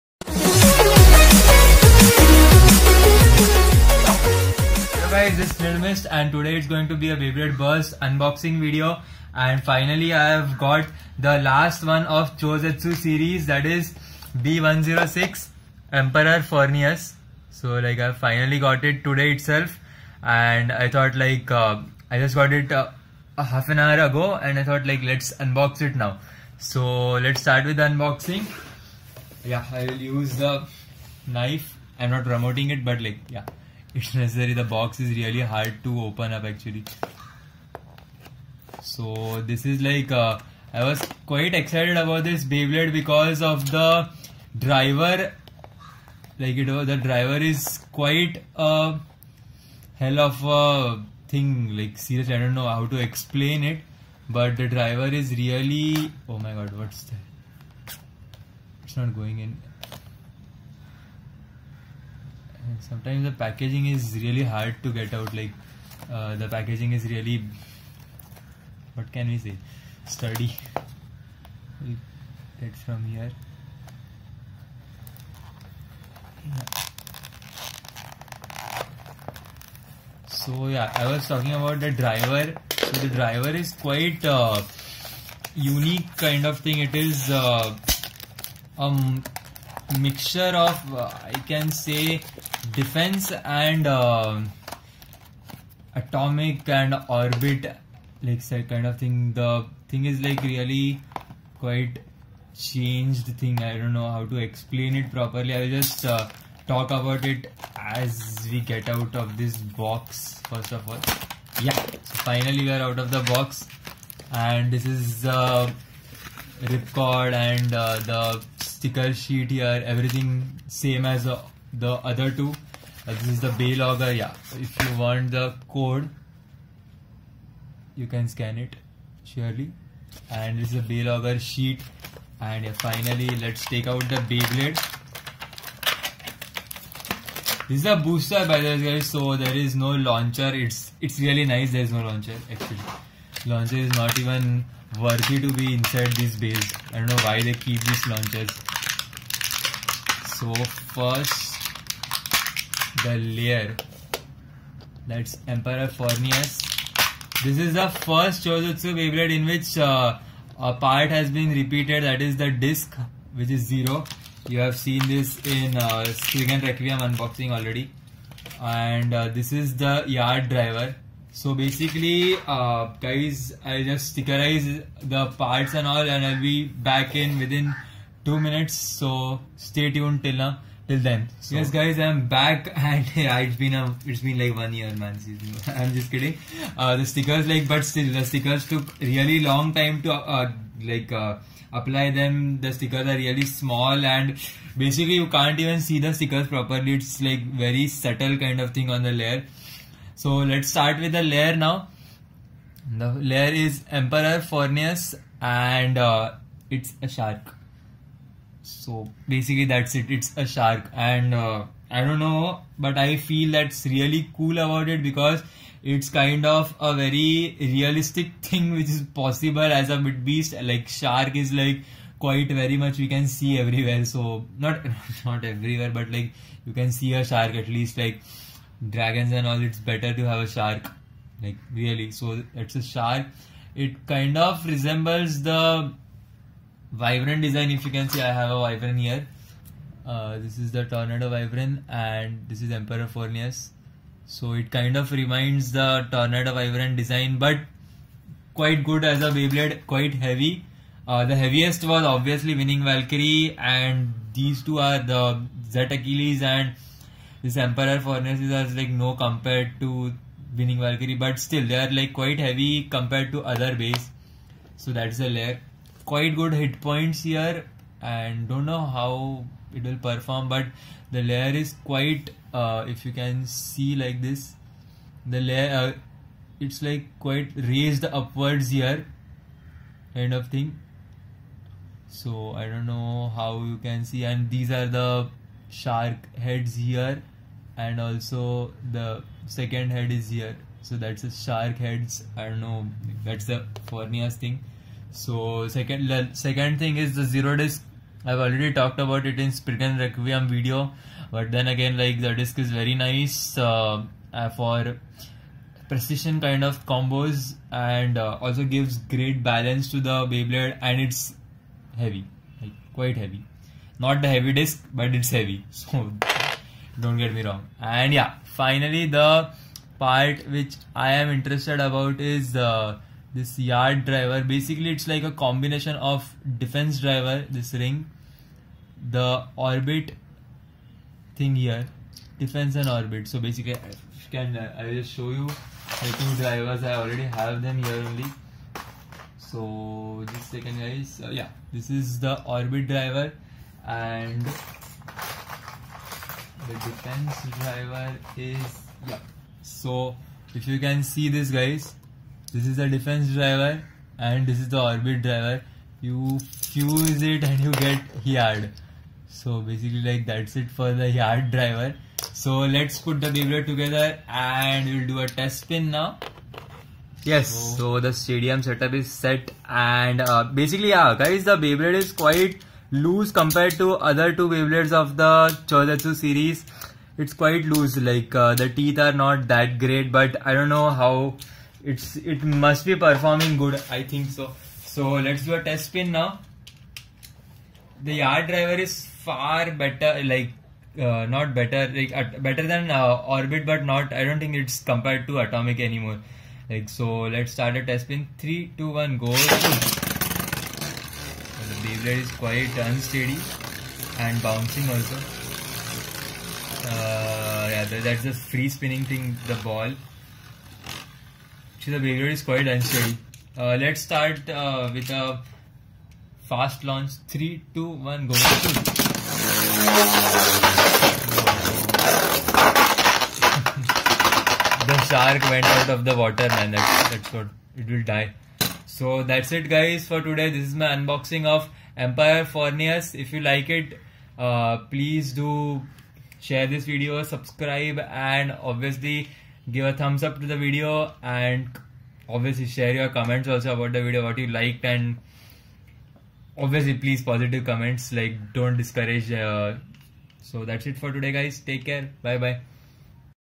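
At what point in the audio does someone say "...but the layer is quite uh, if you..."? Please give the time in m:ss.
4:30.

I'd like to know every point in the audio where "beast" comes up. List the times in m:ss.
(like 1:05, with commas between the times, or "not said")
3:40.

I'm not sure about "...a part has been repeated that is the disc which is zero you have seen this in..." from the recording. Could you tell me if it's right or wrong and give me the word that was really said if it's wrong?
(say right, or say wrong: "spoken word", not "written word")
right.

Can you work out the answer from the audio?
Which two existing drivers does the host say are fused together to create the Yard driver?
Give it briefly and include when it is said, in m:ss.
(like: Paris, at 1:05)
Defense and Orbit, at 5:52.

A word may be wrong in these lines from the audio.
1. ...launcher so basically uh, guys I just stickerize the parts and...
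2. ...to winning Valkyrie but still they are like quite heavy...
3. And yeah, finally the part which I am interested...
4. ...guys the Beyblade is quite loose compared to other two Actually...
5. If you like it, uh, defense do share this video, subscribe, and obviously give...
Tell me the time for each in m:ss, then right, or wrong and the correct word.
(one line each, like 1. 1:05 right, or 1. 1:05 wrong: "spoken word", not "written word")
1. 2:50 wrong: "driver", not "launcher"
2. 4:19 right
3. 5:17 right
4. 6:11 wrong: "Beyblades", not "Actually"
5. 7:13 wrong: "please", not "defense".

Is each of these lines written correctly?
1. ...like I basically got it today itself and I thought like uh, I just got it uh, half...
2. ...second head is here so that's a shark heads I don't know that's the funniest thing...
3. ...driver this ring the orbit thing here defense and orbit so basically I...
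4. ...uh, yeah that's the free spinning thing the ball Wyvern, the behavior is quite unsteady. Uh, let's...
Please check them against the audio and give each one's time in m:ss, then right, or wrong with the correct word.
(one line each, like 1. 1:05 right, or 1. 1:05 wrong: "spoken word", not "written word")
1. 0:17 wrong: "finally", not "basically"
2. 4:49 right
3. 5:26 right
4. 6:46 wrong: "Actually", not "Wyvern".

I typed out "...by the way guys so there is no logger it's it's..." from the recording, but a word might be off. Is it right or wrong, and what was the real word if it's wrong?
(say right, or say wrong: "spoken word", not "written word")
wrong: "launcher", not "logger".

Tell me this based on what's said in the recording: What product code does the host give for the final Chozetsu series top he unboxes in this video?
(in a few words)
B106.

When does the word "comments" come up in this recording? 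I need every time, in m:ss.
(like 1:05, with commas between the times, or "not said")
7:23, 7:27.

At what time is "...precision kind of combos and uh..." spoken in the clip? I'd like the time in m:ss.
5:05.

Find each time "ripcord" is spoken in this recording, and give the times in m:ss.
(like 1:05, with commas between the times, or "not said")
1:56.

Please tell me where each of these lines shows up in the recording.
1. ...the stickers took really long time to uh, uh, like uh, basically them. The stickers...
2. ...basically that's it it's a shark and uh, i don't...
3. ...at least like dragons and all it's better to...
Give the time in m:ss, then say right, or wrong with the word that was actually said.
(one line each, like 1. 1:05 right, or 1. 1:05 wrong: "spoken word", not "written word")
1. 3:08 wrong: "apply", not "basically"
2. 3:29 right
3. 3:47 right.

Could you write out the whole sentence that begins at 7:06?
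That's, that's what it will die.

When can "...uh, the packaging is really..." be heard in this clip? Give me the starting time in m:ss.
1:06.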